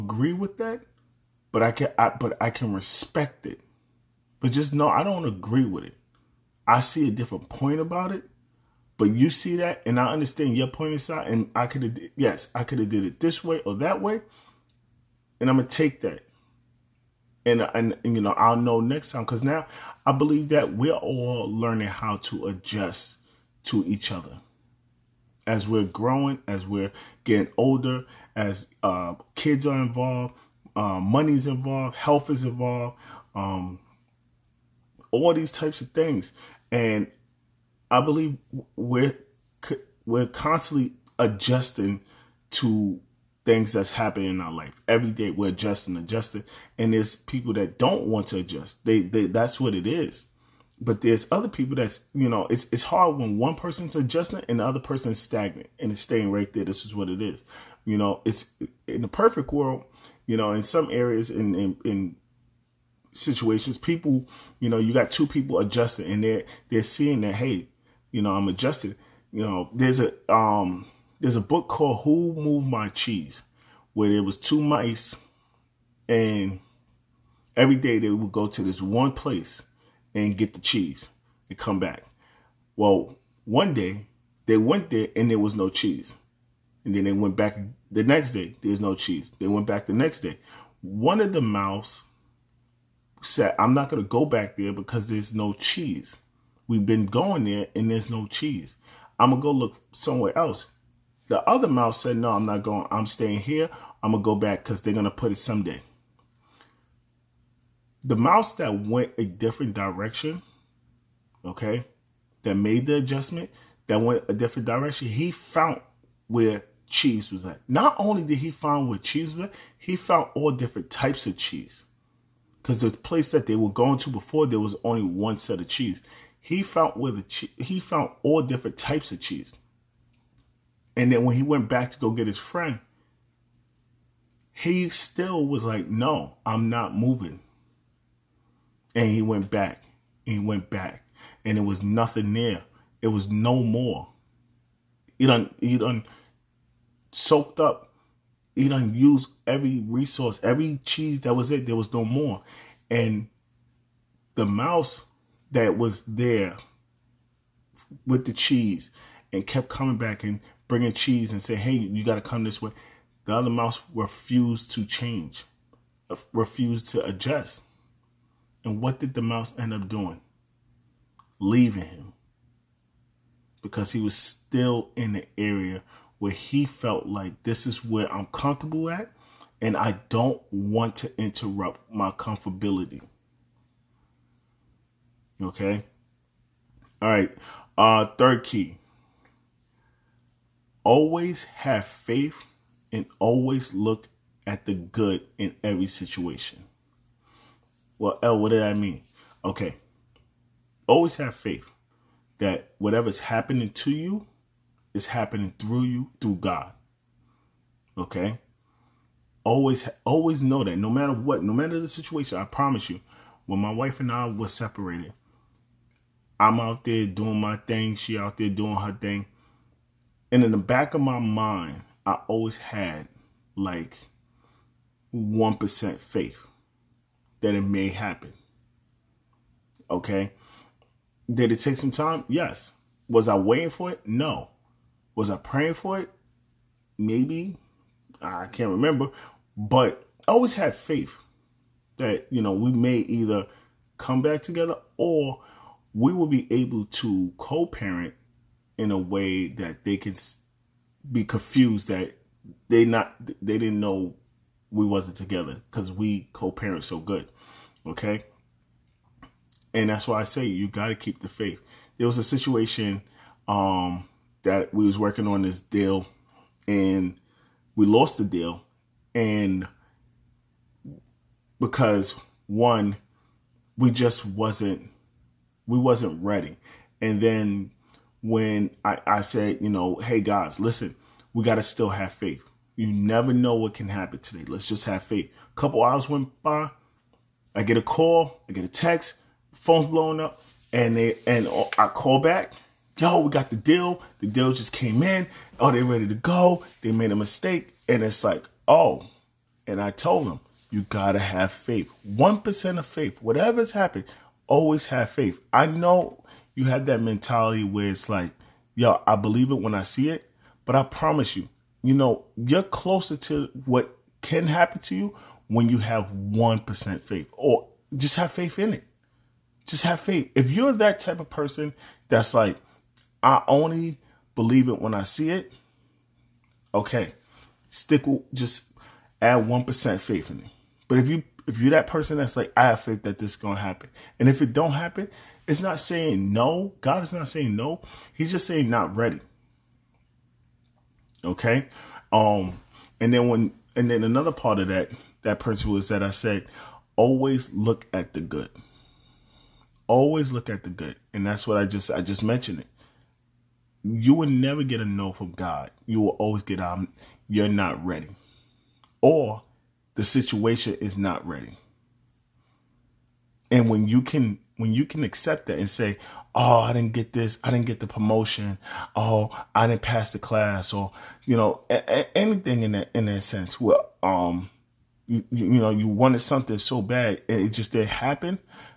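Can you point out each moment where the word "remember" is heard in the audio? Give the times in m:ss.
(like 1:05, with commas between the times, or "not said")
3:58.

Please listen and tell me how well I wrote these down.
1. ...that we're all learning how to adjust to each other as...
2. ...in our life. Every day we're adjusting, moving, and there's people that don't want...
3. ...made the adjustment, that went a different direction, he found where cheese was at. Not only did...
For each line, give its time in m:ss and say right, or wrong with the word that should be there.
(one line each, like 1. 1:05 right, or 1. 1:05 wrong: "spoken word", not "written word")
1. 0:20 right
2. 0:44 wrong: "adjusting", not "moving"
3. 1:52 right.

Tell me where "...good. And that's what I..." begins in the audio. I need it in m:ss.
5:50.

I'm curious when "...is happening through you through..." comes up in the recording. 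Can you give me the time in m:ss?
3:24.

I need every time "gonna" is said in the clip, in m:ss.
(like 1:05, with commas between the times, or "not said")
0:15, 5:33.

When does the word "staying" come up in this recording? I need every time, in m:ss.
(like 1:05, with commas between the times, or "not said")
0:56, 1:43.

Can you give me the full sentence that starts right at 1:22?
Well, one day they went there and there was no cheese.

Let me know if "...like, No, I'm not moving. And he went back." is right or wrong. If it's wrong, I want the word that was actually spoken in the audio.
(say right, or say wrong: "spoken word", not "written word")
right.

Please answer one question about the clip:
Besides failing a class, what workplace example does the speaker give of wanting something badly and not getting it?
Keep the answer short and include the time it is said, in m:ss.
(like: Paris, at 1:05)
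The promotion, at 6:07.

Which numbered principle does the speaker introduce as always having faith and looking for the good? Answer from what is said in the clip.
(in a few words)
Third.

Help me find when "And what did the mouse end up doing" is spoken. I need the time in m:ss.
2:48.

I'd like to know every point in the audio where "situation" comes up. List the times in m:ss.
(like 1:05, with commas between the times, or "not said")
1:03, 3:15, 3:31, 4:22, 6:00.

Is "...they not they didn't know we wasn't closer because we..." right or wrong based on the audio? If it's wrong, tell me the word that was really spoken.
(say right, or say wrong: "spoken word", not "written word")
wrong: "together", not "closer".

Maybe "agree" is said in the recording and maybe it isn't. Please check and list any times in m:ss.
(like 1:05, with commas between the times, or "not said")
0:00, 0:05.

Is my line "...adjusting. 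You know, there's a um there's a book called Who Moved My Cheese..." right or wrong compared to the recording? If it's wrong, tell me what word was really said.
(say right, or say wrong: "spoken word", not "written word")
right.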